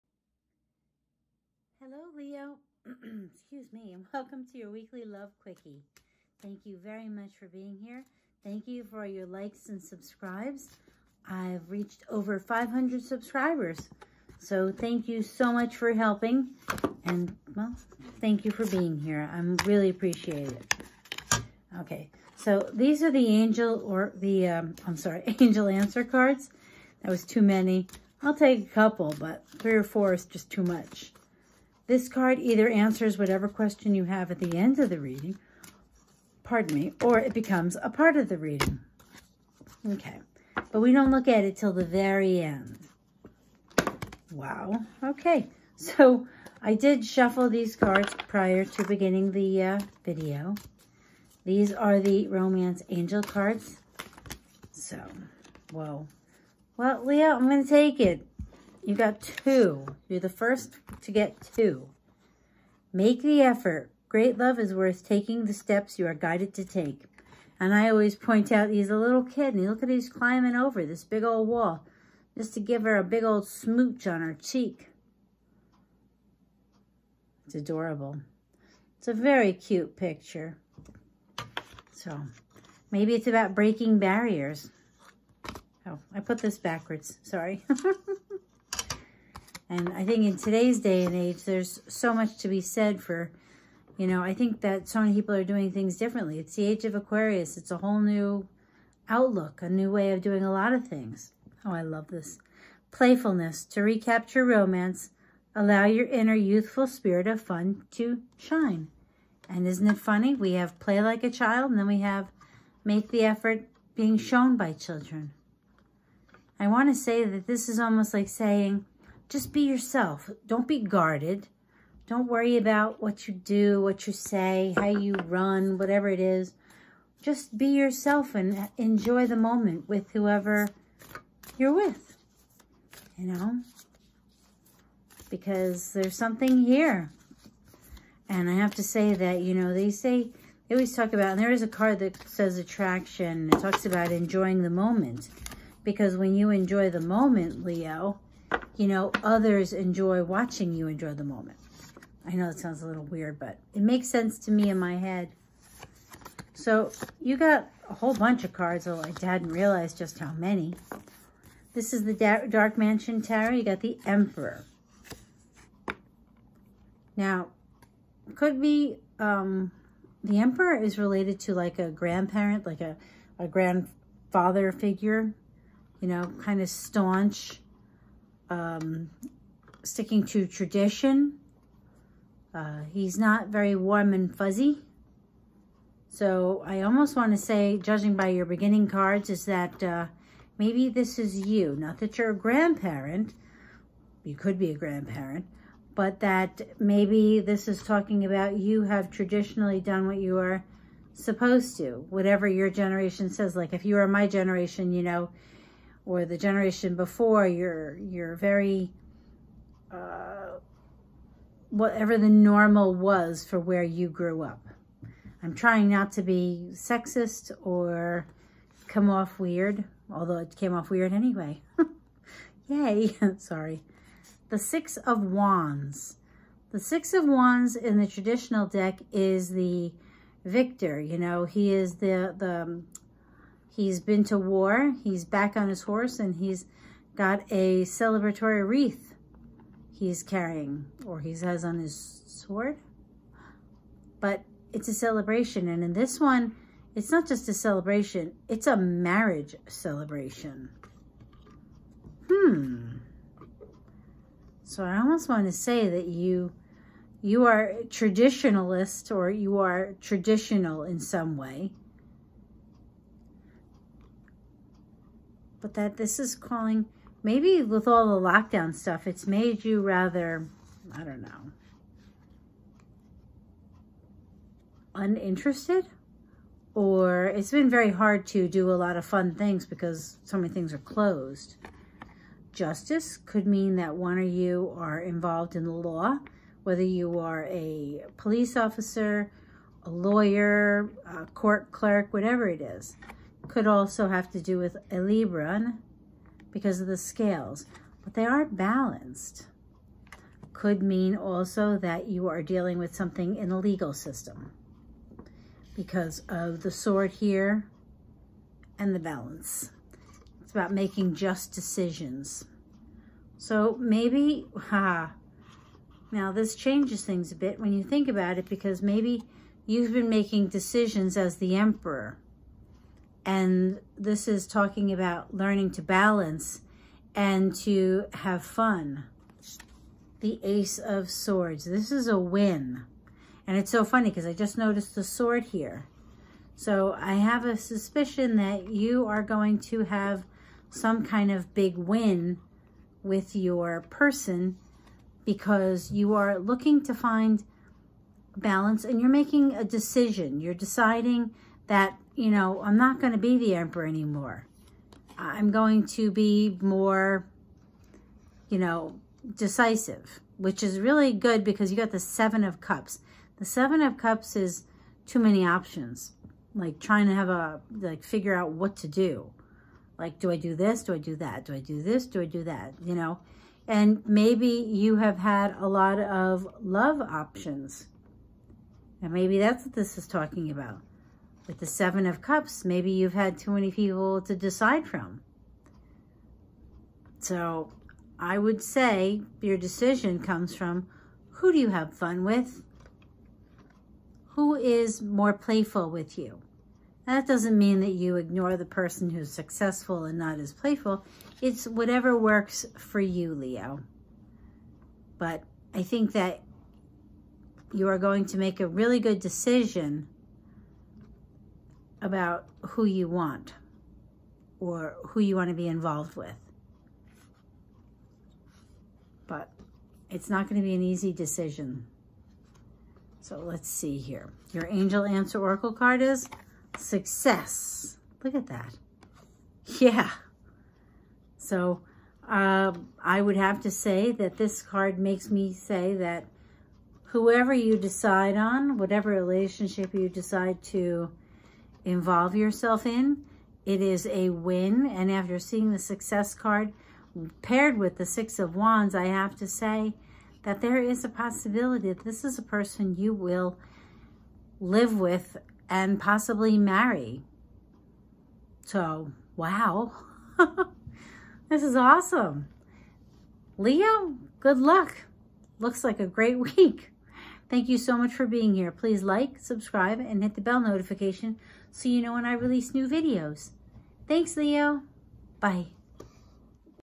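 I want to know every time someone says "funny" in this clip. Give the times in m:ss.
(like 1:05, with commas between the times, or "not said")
1:49, 5:33.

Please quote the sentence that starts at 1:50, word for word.
We have play like a child, and then we have make the effort being shown by children.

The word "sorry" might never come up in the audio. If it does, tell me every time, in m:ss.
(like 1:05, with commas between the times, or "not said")
0:24, 1:27, 3:43.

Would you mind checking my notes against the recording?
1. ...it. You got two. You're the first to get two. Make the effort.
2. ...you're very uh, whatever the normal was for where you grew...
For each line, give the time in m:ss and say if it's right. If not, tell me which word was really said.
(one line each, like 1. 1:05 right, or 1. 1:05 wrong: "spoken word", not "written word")
1. 0:57 right
2. 3:27 right.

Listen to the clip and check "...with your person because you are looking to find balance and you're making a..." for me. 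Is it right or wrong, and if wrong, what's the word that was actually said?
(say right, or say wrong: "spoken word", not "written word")
right.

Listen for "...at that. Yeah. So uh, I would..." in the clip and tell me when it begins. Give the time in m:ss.
7:08.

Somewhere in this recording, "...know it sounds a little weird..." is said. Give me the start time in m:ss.
2:32.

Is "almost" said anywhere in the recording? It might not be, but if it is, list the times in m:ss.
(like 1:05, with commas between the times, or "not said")
1:57, 3:06, 4:14.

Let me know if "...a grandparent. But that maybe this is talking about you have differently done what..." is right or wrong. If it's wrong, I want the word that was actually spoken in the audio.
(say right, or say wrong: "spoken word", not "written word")
wrong: "traditionally", not "differently".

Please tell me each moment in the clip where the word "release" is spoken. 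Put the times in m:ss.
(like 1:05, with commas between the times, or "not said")
7:52.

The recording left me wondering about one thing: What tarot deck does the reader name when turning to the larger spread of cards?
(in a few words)
Dark Mansion Tarot.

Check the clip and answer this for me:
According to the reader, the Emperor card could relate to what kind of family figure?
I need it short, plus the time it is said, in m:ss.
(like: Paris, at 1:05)
grandfather, at 2:53.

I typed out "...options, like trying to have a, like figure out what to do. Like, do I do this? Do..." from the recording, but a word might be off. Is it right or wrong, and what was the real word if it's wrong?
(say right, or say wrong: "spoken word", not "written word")
right.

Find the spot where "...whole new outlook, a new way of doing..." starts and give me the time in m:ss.
1:37.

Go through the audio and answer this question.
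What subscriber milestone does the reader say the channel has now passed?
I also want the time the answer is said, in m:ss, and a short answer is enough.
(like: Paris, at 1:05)
500, at 0:12.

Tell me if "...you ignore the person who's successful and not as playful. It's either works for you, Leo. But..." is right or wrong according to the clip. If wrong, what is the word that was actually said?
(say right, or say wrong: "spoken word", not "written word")
wrong: "whatever", not "either".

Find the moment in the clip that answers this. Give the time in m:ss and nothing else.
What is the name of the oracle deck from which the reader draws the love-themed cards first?
0:52.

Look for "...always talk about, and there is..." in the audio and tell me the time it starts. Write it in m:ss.
2:20.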